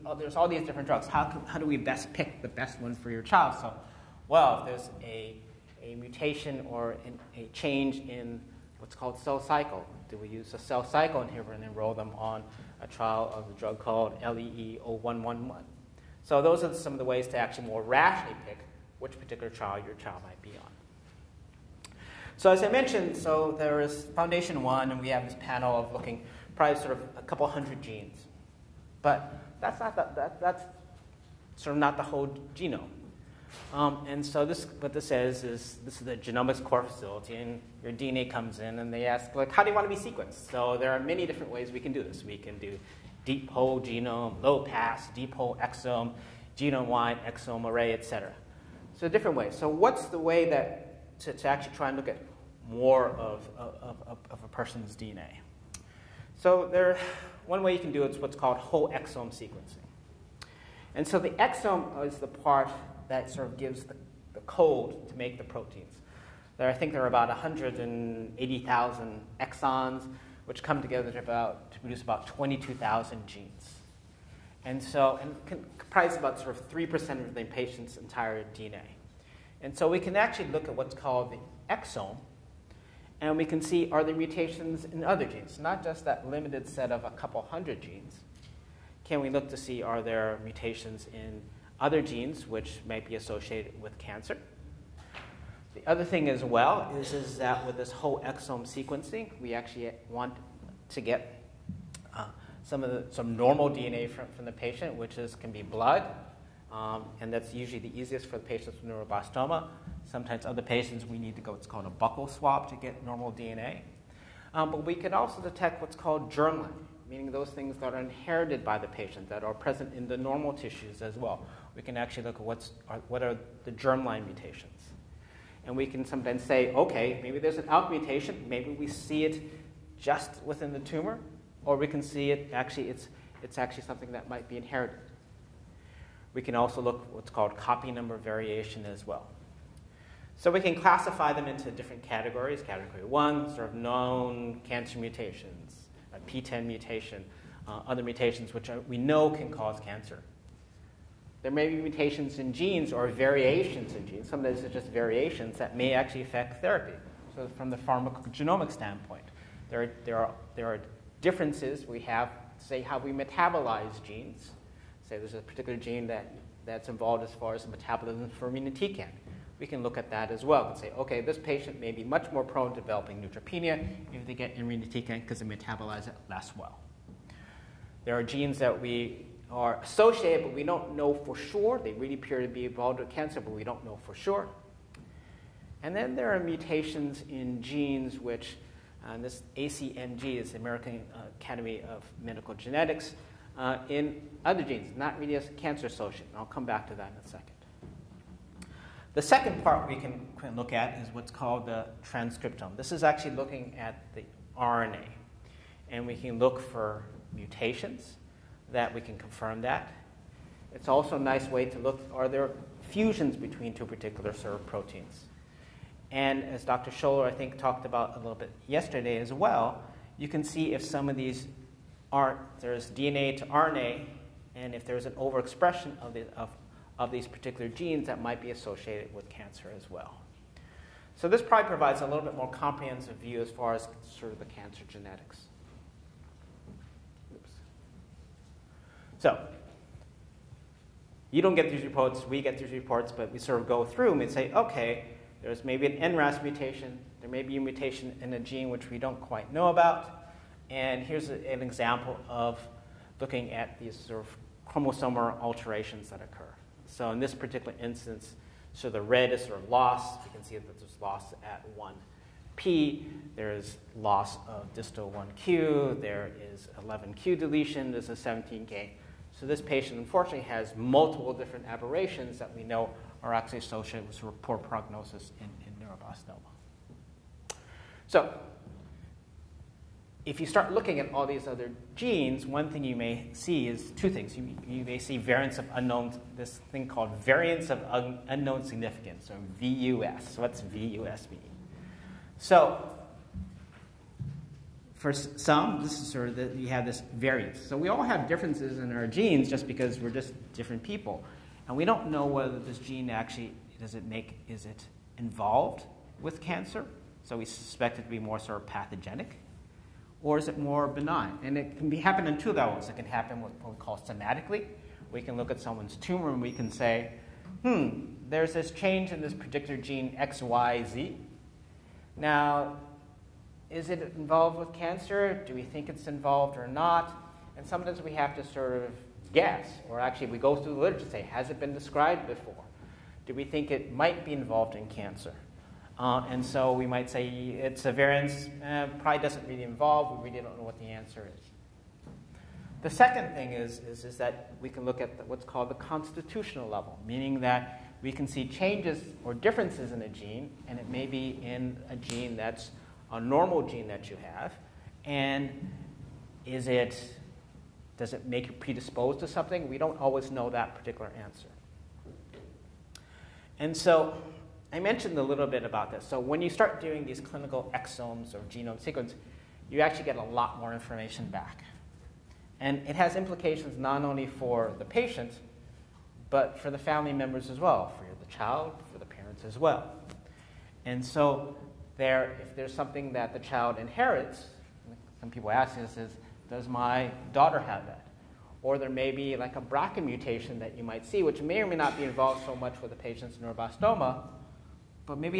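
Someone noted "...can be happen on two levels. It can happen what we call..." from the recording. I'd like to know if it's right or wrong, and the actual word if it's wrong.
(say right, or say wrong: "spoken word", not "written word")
right.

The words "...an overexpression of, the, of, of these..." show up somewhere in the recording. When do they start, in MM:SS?
03:45.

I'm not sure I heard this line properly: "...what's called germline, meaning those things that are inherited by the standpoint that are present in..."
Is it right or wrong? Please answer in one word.
wrong.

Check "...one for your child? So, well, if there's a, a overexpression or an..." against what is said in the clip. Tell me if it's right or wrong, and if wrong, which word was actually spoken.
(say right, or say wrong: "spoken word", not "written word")
wrong: "mutation", not "overexpression".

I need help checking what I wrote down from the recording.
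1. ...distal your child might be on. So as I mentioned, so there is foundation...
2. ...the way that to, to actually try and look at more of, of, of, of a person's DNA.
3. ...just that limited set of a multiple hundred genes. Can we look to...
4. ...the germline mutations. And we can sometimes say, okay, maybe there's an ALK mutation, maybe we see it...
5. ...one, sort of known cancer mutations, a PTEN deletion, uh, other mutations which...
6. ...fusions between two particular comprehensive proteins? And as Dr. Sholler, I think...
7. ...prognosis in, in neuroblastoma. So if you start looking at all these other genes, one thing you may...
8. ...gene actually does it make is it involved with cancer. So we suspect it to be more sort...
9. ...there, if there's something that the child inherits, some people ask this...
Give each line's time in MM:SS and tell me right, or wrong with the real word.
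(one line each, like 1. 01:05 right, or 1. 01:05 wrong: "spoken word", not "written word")
1. 00:19 wrong: "trial", not "distal"
2. 00:50 right
3. 01:25 wrong: "couple", not "multiple"
4. 02:03 right
5. 02:23 wrong: "mutation", not "deletion"
6. 03:32 wrong: "serve", not "comprehensive"
7. 04:34 right
8. 05:02 right
9. 06:21 right.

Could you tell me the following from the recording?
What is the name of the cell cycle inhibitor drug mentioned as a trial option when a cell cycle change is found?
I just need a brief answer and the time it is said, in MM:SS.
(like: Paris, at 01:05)
LEE0111, at 00:14.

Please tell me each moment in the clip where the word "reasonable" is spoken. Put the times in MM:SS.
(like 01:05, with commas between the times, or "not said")
not said.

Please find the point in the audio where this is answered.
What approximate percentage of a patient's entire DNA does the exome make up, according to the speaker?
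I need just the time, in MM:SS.
01:16.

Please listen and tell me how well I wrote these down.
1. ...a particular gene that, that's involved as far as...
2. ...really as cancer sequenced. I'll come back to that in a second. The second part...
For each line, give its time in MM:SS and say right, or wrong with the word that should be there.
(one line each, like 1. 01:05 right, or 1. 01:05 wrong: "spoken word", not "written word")
1. 02:45 right
2. 03:15 wrong: "associated", not "sequenced".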